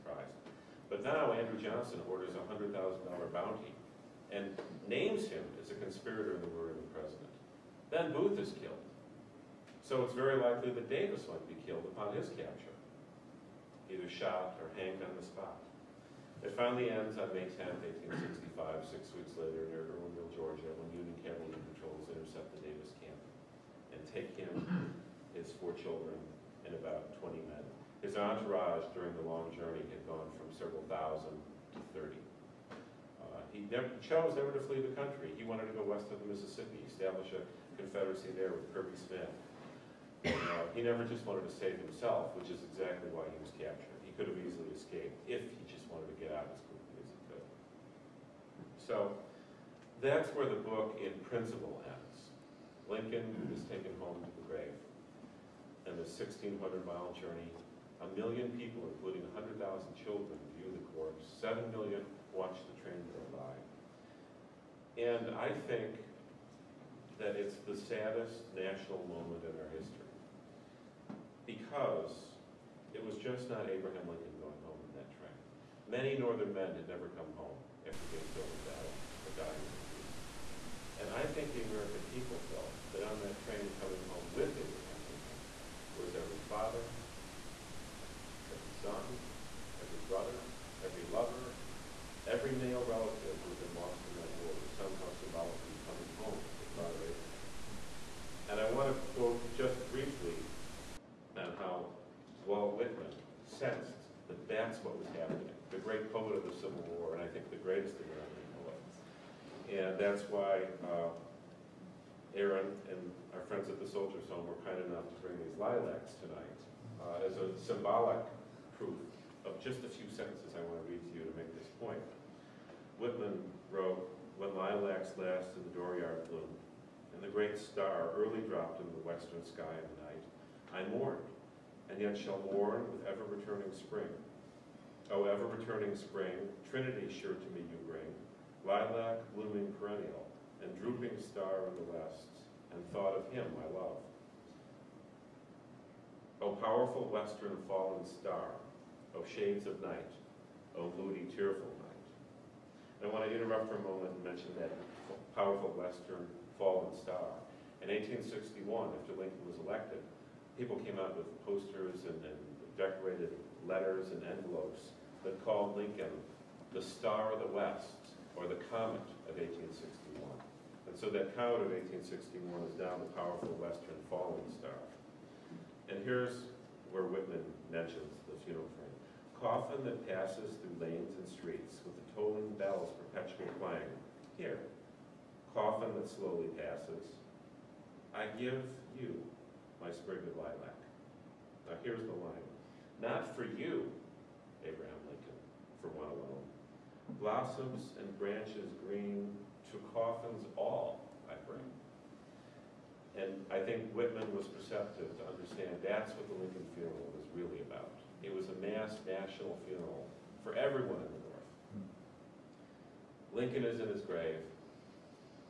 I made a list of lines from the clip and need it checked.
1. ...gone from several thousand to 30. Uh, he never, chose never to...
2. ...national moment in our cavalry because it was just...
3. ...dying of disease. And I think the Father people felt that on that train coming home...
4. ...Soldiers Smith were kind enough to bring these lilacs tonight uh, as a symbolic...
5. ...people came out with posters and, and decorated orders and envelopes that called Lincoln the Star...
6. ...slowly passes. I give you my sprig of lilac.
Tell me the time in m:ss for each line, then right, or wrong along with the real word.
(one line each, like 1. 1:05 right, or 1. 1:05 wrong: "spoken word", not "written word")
1. 0:30 right
2. 1:08 wrong: "history", not "cavalry"
3. 1:19 wrong: "American", not "Father"
4. 1:53 wrong: "Home", not "Smith"
5. 2:40 wrong: "letters", not "orders"
6. 3:06 right.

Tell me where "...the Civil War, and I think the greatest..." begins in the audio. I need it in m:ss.
1:46.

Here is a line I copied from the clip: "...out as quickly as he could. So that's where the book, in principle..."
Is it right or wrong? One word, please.
right.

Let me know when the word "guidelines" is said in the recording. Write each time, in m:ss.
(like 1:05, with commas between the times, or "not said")
not said.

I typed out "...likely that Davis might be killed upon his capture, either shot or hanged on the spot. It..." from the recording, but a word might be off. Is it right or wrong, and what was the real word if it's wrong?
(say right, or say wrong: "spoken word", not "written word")
right.